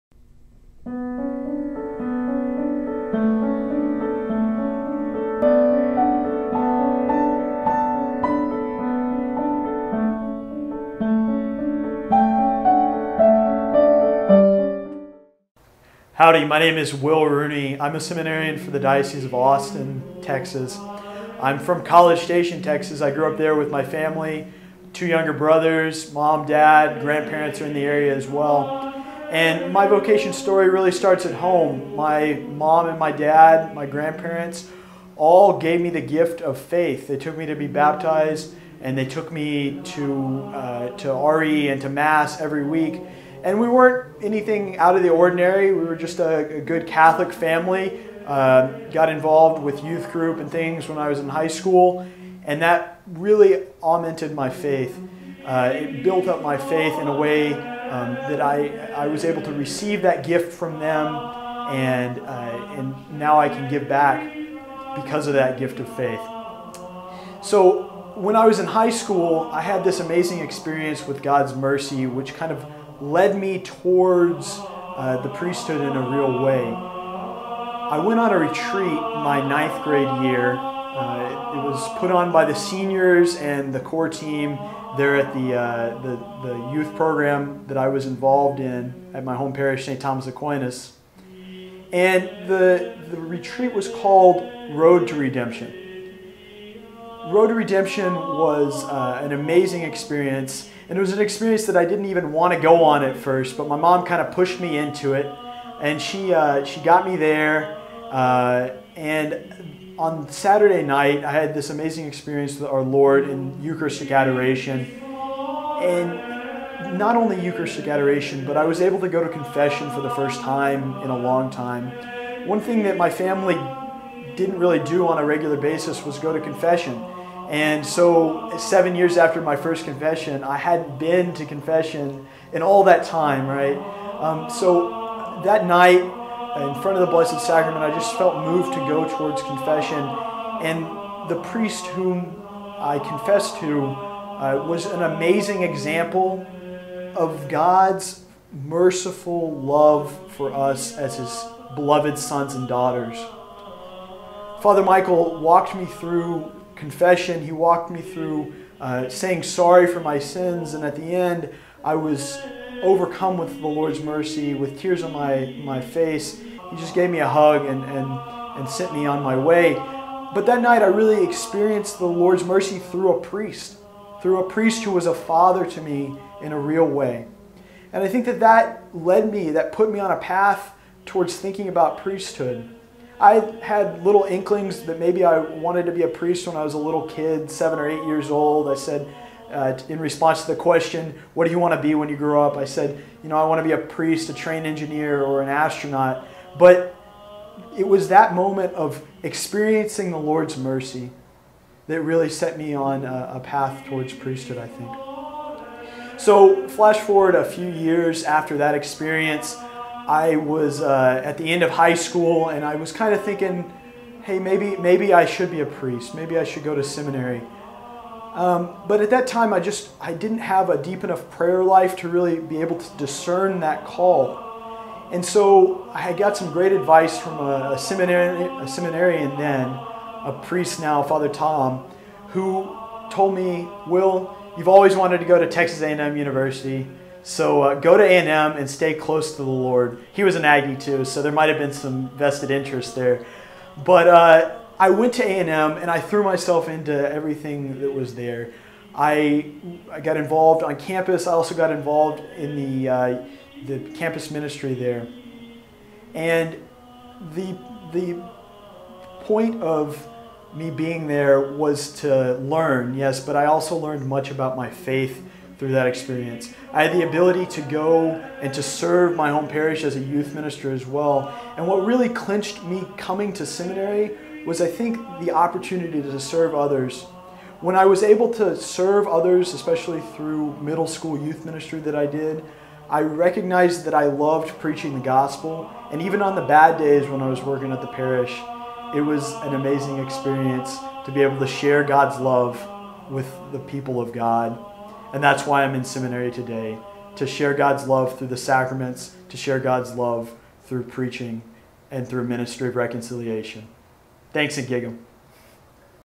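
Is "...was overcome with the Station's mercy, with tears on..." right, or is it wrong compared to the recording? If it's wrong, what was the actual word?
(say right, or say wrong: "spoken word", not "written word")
wrong: "Lord", not "Station".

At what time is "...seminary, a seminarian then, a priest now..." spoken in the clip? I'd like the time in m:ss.
3:47.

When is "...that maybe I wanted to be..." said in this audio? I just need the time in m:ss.
3:04.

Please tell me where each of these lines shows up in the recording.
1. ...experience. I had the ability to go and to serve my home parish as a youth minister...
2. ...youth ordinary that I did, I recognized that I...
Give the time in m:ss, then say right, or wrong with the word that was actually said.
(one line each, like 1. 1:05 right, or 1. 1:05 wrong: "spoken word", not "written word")
1. 4:25 right
2. 4:41 wrong: "ministry", not "ordinary".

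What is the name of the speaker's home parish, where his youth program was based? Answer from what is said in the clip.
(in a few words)
St. Thomas Aquinas.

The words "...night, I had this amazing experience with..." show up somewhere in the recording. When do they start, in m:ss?
1:50.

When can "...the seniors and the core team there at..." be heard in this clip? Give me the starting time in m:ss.
1:22.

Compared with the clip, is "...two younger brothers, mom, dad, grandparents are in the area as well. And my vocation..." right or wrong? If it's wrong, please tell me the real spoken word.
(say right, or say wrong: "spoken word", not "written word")
right.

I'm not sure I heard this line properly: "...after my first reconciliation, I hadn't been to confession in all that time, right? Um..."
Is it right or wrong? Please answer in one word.
wrong.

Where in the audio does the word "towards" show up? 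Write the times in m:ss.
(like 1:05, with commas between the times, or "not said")
1:13, 2:19, 3:01, 3:23.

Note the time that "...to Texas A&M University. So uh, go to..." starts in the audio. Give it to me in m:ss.
3:55.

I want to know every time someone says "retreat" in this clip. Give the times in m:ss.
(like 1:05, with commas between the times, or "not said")
1:18, 1:33.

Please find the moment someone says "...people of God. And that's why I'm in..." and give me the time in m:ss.
4:53.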